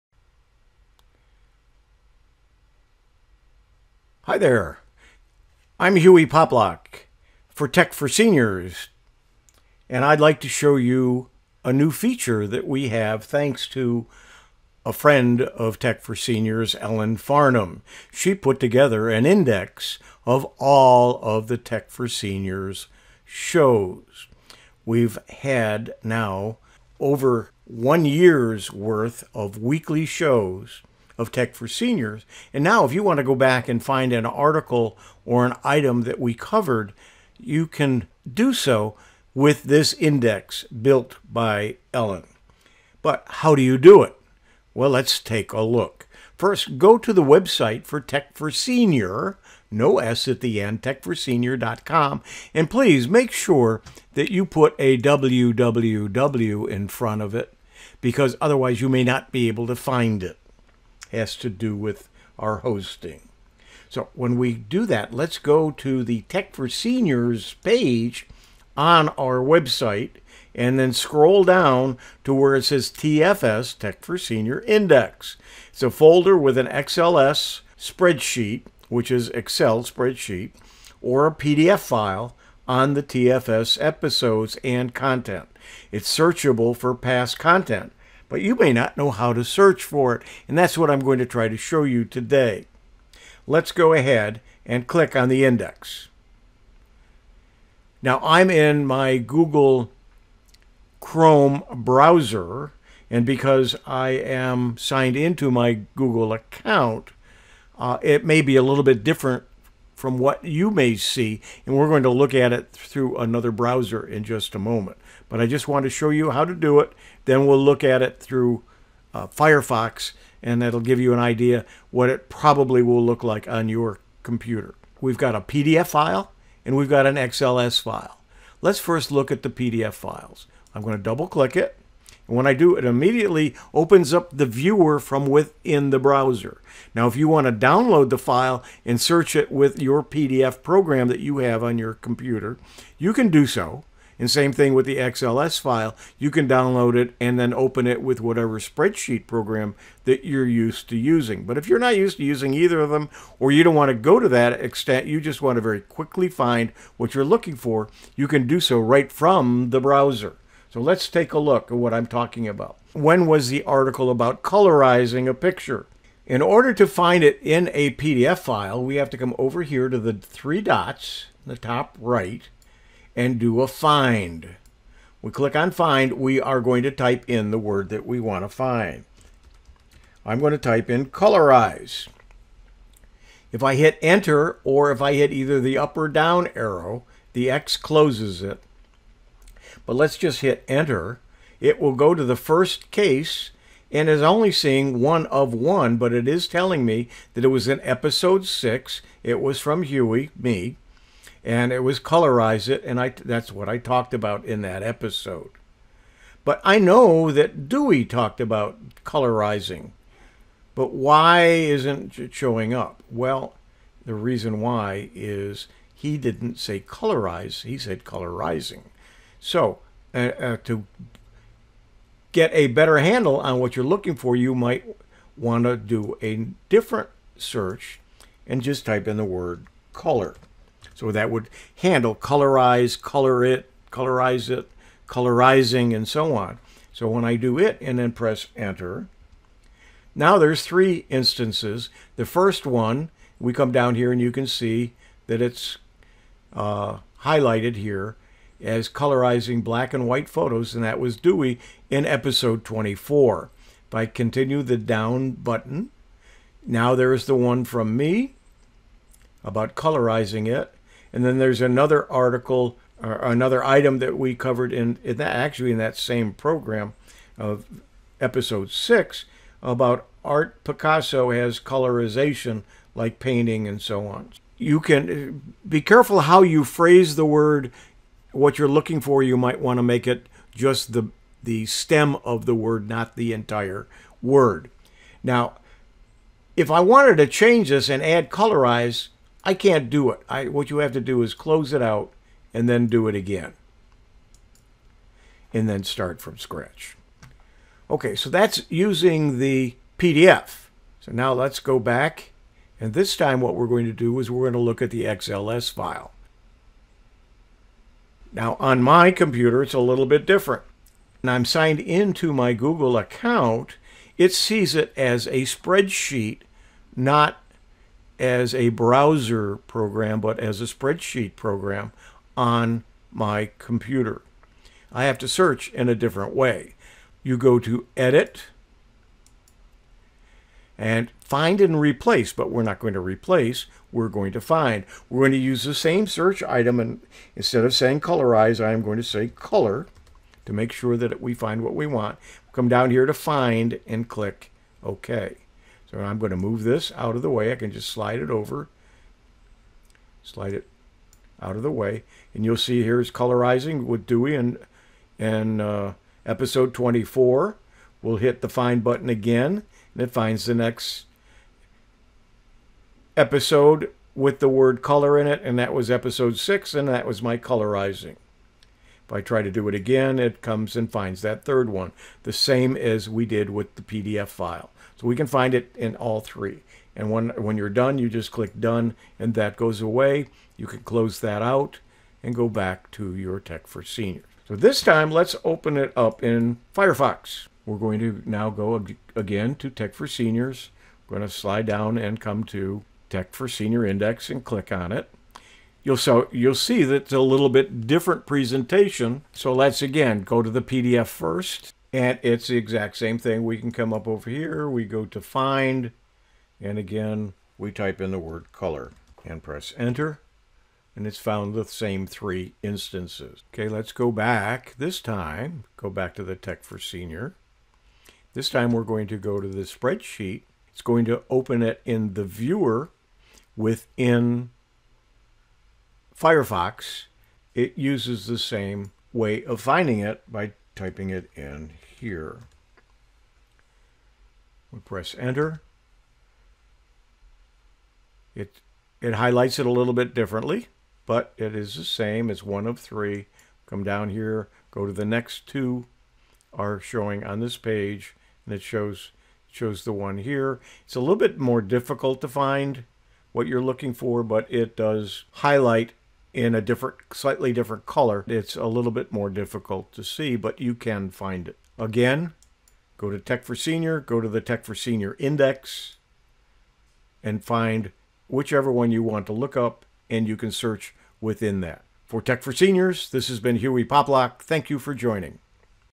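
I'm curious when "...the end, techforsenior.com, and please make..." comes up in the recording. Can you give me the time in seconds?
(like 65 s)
50 s.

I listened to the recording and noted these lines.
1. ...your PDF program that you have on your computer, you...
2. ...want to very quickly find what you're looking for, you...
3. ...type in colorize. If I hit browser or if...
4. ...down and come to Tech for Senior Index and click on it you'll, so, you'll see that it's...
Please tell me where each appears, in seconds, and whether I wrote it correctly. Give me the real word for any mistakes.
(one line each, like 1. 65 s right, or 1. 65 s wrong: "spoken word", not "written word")
1. 139 s right
2. 155 s right
3. 180 s wrong: "enter", not "browser"
4. 391 s right.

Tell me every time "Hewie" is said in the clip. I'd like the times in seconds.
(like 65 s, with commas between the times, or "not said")
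5 s, 199 s, 473 s.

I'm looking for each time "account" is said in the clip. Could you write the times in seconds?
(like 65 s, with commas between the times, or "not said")
106 s, 312 s.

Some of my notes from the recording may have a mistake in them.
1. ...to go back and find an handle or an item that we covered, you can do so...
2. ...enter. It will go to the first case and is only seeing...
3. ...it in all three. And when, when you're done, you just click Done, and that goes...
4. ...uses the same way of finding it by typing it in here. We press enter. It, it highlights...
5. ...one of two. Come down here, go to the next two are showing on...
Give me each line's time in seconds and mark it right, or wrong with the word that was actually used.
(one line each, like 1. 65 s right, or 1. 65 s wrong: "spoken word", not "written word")
1. 33 s wrong: "article", not "handle"
2. 190 s right
3. 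375 s right
4. 427 s right
5. 442 s wrong: "three", not "two".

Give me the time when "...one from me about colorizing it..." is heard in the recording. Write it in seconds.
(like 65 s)
257 s.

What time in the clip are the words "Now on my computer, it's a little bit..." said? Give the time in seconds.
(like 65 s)
308 s.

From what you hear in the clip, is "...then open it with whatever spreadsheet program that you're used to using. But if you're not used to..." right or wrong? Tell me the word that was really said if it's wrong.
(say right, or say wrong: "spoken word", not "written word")
right.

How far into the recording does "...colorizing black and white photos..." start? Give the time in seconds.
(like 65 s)
248 s.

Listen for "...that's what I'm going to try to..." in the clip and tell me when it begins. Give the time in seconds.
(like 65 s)
90 s.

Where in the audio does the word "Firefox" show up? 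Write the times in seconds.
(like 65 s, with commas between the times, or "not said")
119 s, 386 s, 426 s.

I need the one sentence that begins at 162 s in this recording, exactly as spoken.
When was the article about colorizing a picture?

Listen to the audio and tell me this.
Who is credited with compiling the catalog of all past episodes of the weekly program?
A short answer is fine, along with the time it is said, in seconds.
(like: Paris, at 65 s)
Ellen Farnham, at 16 s.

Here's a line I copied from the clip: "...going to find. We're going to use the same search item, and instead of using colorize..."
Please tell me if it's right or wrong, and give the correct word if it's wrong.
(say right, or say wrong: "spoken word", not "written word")
wrong: "saying", not "using".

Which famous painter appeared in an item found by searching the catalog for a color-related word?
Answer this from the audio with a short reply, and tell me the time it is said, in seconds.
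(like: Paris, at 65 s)
Picasso, at 270 s.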